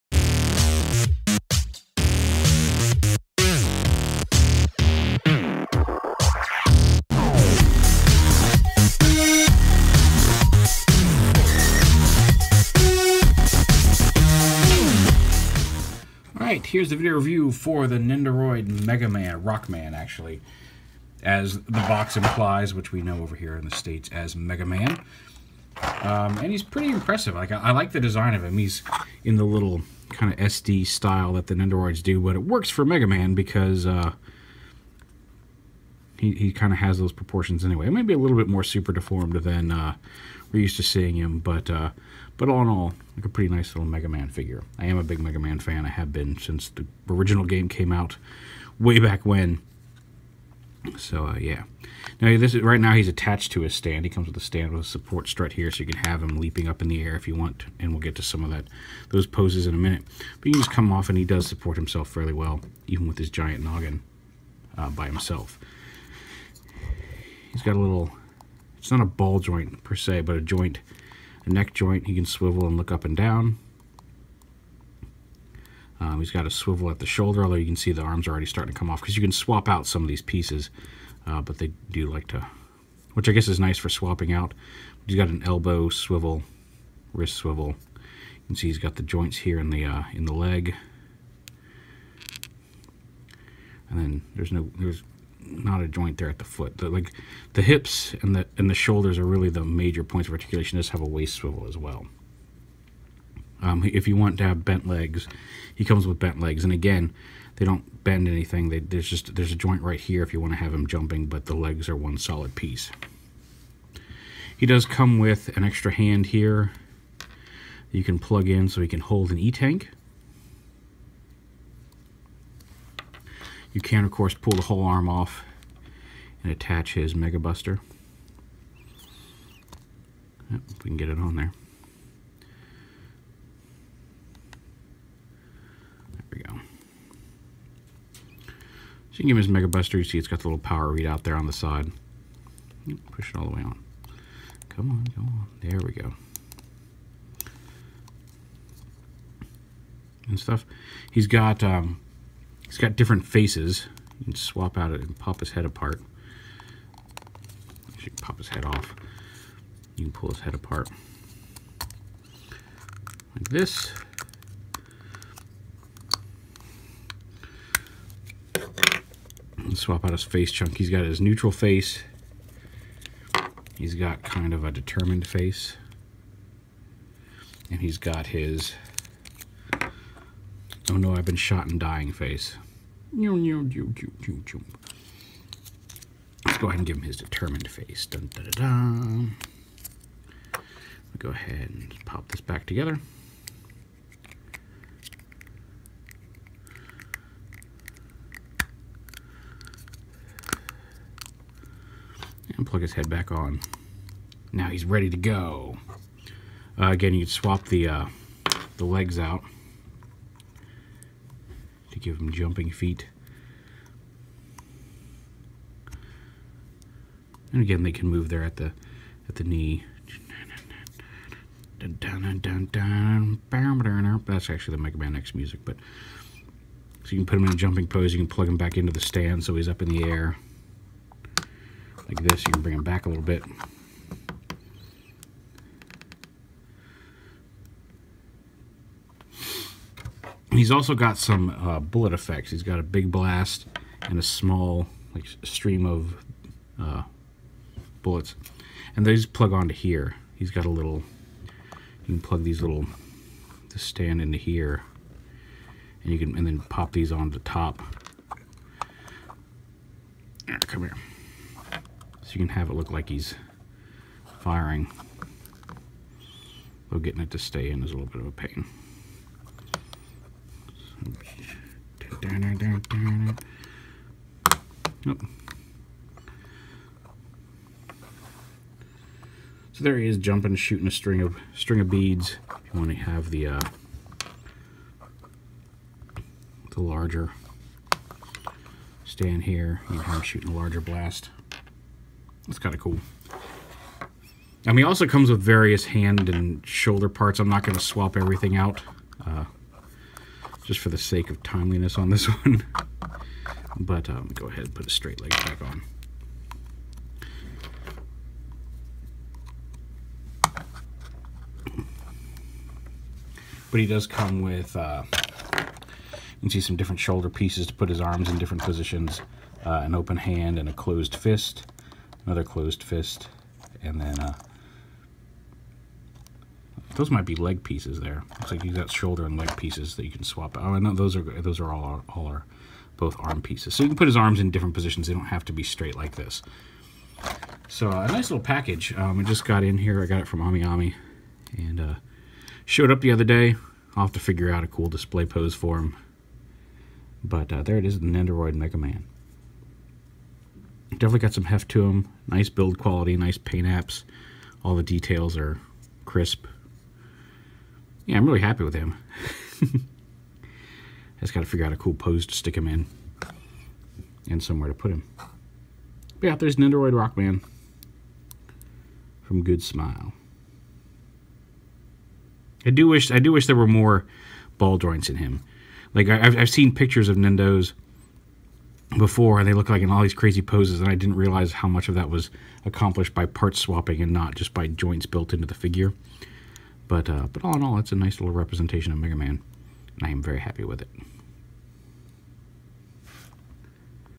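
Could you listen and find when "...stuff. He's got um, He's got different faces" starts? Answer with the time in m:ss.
2:30.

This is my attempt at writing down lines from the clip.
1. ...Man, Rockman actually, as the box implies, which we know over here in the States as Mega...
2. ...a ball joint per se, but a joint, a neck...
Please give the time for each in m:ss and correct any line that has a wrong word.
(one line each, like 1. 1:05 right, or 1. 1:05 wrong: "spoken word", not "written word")
1. 0:19 right
2. 1:09 right.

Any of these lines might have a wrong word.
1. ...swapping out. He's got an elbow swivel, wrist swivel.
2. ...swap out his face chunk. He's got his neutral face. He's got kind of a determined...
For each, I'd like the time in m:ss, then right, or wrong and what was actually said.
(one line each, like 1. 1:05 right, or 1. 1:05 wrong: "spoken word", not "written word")
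1. 1:23 right
2. 2:49 right.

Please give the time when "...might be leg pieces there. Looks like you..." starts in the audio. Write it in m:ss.
5:27.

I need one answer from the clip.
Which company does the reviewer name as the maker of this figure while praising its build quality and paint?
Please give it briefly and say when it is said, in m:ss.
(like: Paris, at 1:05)
Good Smile, at 6:09.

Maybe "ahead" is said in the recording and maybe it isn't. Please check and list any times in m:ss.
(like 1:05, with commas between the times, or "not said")
3:06, 3:11, 5:04.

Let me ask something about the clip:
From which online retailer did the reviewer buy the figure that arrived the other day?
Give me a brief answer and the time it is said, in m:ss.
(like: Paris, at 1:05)
AmiAmi, at 5:40.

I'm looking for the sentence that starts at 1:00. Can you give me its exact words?
But you can just come off, and he does support himself fairly well, even with his giant noggin uh, by himself.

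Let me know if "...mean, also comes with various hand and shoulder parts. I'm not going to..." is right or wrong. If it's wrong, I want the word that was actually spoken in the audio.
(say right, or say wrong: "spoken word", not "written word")
right.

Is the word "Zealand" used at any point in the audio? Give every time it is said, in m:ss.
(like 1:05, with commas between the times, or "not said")
not said.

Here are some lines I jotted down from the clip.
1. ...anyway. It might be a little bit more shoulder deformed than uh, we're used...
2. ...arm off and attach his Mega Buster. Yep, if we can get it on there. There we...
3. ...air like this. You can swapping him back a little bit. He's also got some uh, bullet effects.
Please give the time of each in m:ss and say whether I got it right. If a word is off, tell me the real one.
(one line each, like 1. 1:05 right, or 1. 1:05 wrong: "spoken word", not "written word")
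1. 0:37 wrong: "super", not "shoulder"
2. 2:04 right
3. 3:50 wrong: "bring", not "swapping".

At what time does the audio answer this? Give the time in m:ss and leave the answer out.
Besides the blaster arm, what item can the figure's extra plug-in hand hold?
1:59.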